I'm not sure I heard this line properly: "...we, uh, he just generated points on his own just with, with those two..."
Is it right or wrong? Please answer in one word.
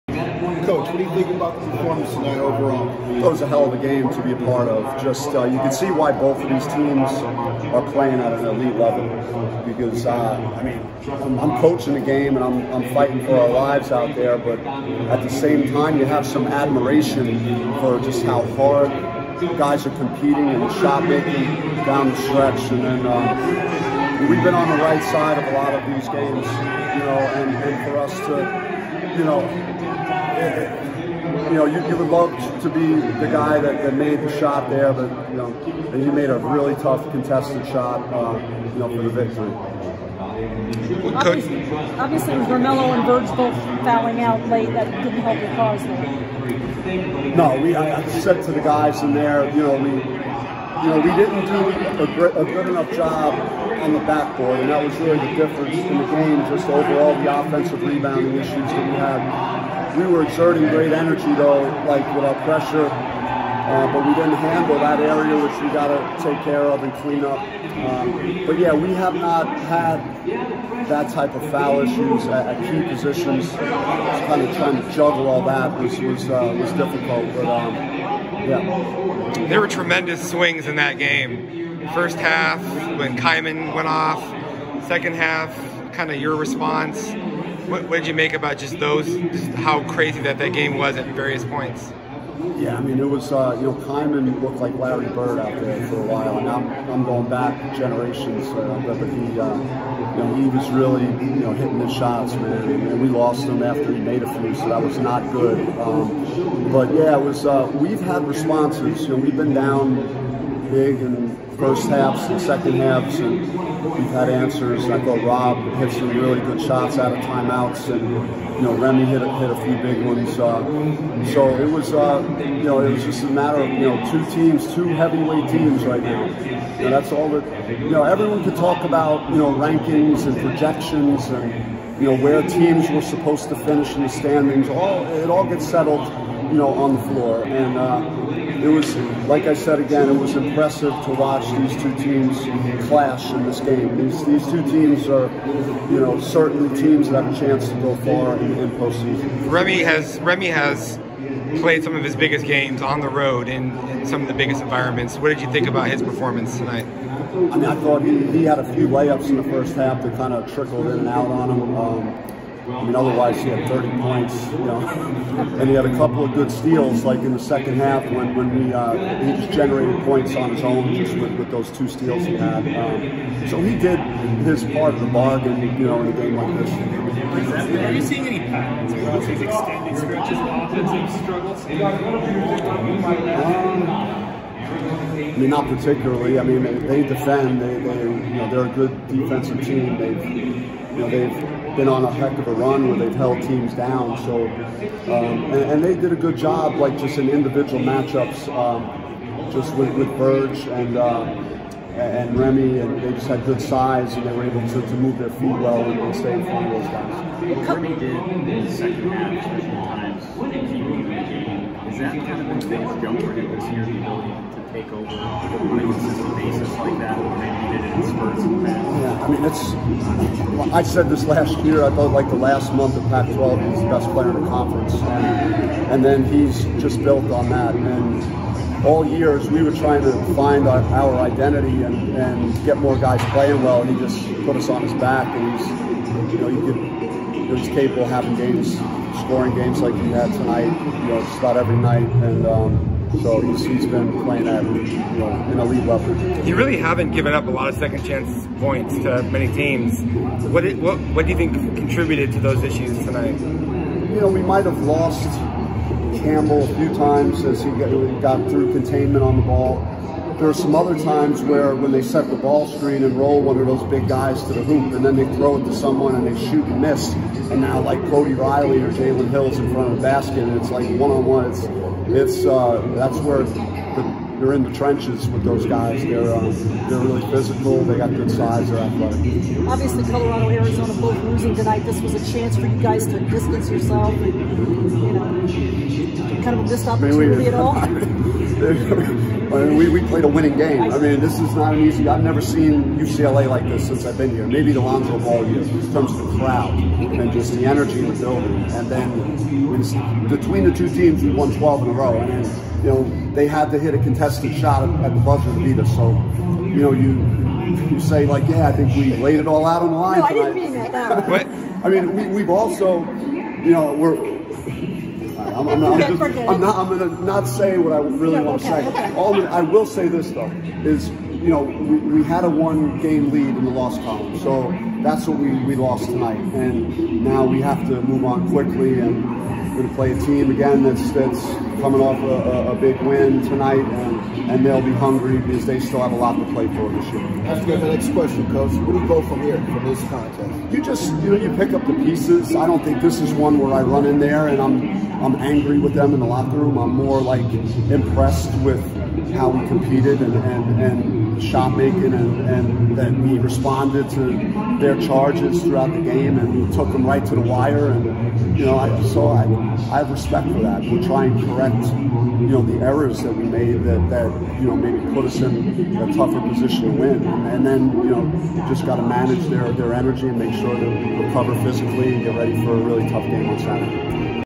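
right.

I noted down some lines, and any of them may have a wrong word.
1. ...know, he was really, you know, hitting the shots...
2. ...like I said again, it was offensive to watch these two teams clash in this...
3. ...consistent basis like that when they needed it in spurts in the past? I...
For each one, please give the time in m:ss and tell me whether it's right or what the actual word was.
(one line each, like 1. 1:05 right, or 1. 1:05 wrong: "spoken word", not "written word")
1. 1:40 right
2. 2:19 wrong: "impressive", not "offensive"
3. 3:35 right.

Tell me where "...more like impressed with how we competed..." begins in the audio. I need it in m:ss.
5:46.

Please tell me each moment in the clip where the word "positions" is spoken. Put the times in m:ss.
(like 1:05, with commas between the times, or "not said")
1:12, 6:06.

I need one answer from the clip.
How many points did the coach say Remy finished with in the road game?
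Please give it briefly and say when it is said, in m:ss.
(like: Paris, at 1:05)
30, at 2:43.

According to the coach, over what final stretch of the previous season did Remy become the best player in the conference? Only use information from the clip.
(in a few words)
last month of Pac-12.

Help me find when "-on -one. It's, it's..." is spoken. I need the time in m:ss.
4:31.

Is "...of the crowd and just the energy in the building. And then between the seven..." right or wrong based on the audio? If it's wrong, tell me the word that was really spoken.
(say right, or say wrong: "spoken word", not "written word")
wrong: "two", not "seven".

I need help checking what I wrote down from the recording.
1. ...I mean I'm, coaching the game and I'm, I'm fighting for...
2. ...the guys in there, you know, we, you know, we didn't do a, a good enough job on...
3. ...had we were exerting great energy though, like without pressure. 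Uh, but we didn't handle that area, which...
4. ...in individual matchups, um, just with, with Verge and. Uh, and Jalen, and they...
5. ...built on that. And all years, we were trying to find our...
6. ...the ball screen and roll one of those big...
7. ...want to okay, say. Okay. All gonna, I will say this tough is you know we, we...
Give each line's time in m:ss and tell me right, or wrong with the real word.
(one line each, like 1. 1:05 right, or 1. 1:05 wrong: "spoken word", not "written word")
1. 0:10 right
2. 0:48 right
3. 0:58 right
4. 3:17 wrong: "Remy", not "Jalen"
5. 3:47 right
6. 4:22 right
7. 5:18 wrong: "though", not "tough".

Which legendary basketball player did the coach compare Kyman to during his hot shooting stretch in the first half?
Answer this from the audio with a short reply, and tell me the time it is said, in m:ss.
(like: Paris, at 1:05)
Larry Bird, at 1:34.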